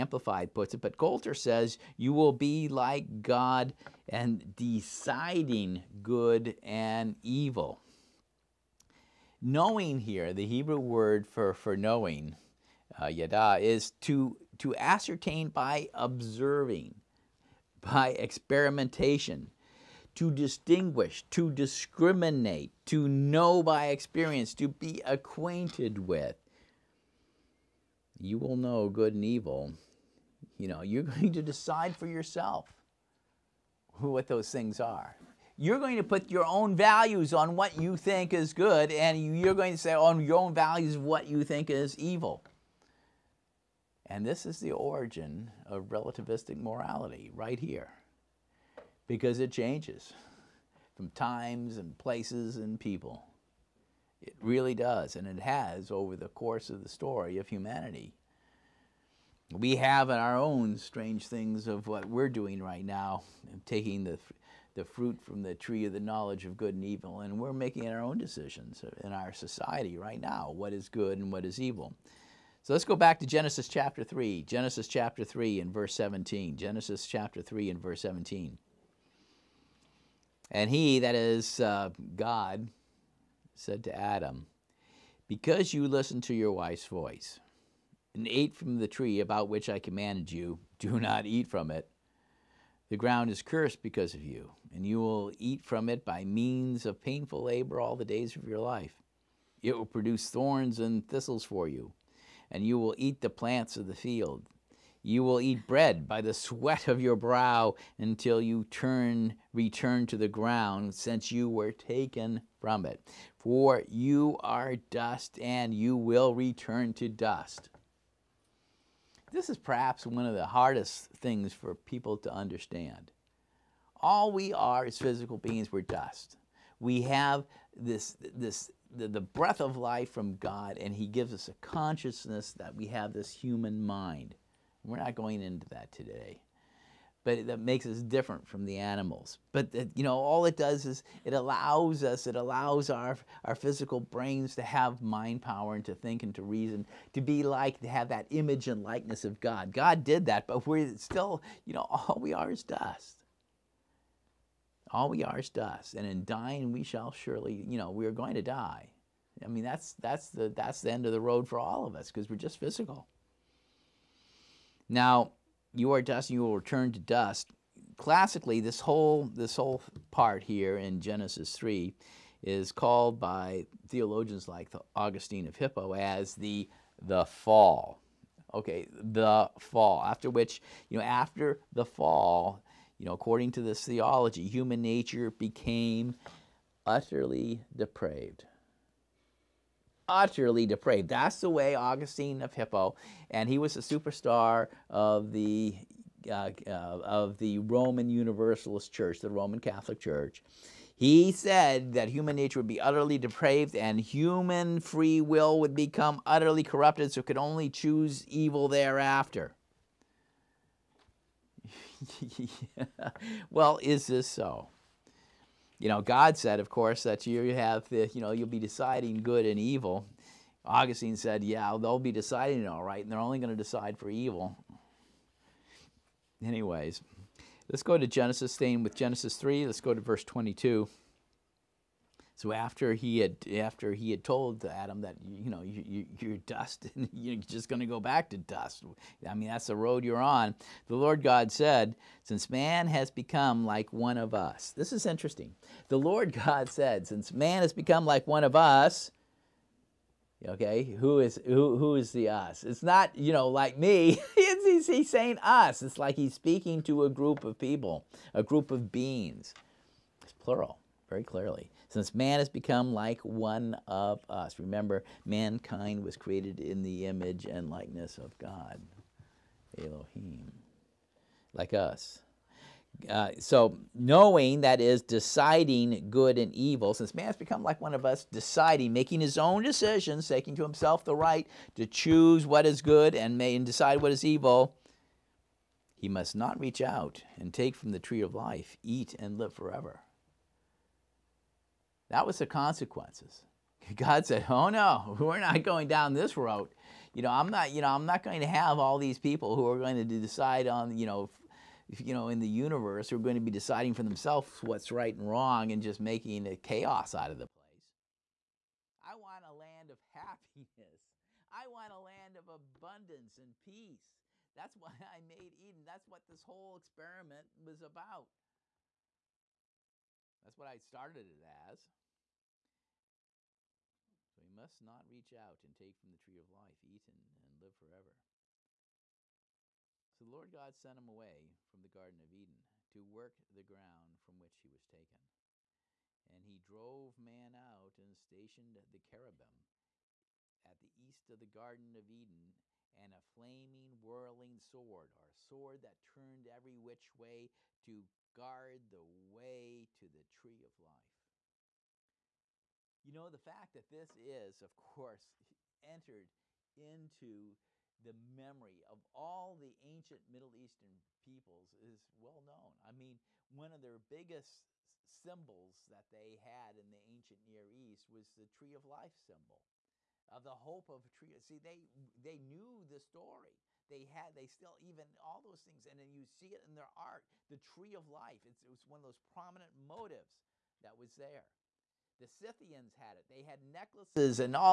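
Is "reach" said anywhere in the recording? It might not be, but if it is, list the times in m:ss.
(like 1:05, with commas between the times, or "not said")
4:46, 5:25.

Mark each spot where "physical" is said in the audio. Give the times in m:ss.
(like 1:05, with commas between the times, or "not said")
2:04, 2:23, 2:42.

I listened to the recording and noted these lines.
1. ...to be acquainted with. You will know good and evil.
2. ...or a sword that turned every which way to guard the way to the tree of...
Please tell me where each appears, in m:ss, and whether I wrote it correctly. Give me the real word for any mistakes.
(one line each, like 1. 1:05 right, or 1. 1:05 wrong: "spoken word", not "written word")
1. 0:24 right
2. 5:45 right.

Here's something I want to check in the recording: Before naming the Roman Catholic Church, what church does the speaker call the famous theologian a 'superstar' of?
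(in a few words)
Roman Universalist Church.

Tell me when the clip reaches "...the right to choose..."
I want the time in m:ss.
4:41.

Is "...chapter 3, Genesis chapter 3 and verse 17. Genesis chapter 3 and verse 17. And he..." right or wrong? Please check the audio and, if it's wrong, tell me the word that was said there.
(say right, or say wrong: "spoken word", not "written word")
right.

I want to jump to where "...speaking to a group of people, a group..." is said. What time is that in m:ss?
4:16.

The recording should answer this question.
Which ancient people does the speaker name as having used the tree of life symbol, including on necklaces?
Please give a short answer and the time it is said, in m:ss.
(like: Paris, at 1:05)
Scythians, at 6:22.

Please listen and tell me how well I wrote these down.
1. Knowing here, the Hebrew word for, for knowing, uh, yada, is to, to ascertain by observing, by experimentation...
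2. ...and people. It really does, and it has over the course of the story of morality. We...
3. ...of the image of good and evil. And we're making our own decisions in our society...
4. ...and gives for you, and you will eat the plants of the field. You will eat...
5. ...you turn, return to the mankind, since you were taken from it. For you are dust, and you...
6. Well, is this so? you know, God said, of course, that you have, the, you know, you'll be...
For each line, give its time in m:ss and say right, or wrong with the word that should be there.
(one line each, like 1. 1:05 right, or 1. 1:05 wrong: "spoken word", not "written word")
1. 0:09 right
2. 0:52 wrong: "humanity", not "morality"
3. 1:05 wrong: "knowledge", not "image"
4. 1:40 wrong: "thistles", not "gives"
5. 1:48 wrong: "ground", not "mankind"
6. 3:33 right.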